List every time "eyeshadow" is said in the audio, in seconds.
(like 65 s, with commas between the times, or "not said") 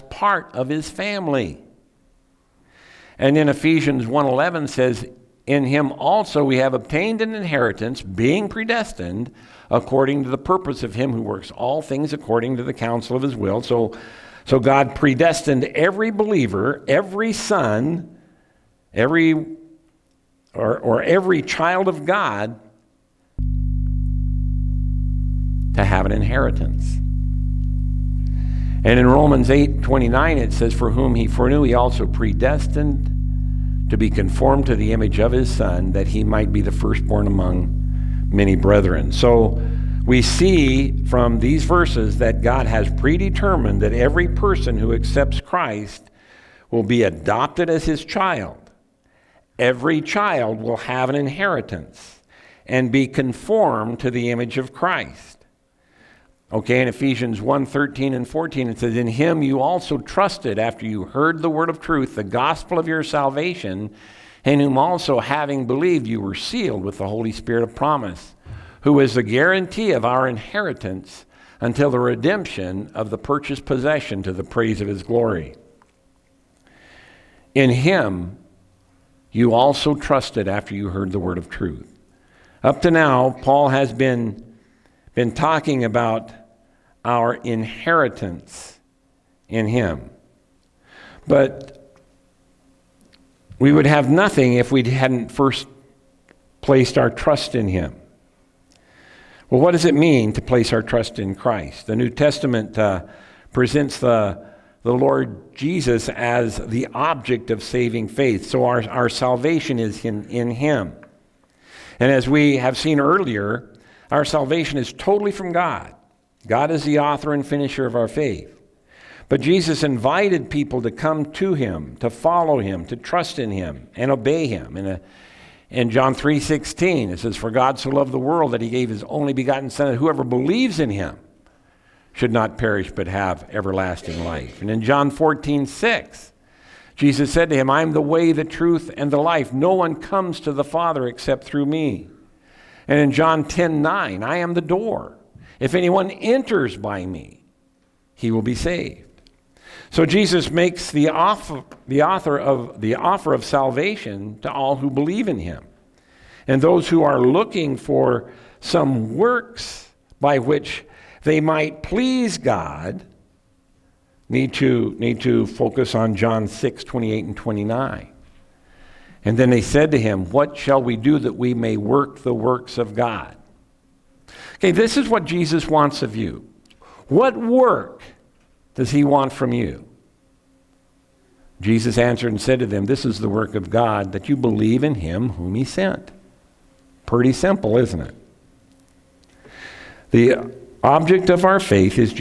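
not said.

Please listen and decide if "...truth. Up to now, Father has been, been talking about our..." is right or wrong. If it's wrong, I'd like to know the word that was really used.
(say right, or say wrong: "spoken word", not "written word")
wrong: "Paul", not "Father".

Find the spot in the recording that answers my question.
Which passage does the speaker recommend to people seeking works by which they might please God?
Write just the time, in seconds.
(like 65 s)
166 s.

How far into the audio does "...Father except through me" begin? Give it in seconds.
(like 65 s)
140 s.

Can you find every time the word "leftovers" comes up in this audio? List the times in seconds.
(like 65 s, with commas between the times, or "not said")
not said.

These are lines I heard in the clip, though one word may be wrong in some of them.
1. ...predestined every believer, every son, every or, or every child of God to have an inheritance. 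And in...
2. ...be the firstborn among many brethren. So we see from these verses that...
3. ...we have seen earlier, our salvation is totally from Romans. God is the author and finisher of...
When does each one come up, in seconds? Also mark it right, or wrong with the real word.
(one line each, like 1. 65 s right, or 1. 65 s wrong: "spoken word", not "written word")
1. 14 s right
2. 36 s right
3. 112 s wrong: "God", not "Romans".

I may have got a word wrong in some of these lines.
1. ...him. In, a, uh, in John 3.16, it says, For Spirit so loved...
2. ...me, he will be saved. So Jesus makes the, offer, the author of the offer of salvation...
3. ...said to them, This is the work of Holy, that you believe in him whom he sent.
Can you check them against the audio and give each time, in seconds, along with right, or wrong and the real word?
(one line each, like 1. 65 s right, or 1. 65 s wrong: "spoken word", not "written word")
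1. 124 s wrong: "God", not "Spirit"
2. 147 s right
3. 182 s wrong: "God", not "Holy".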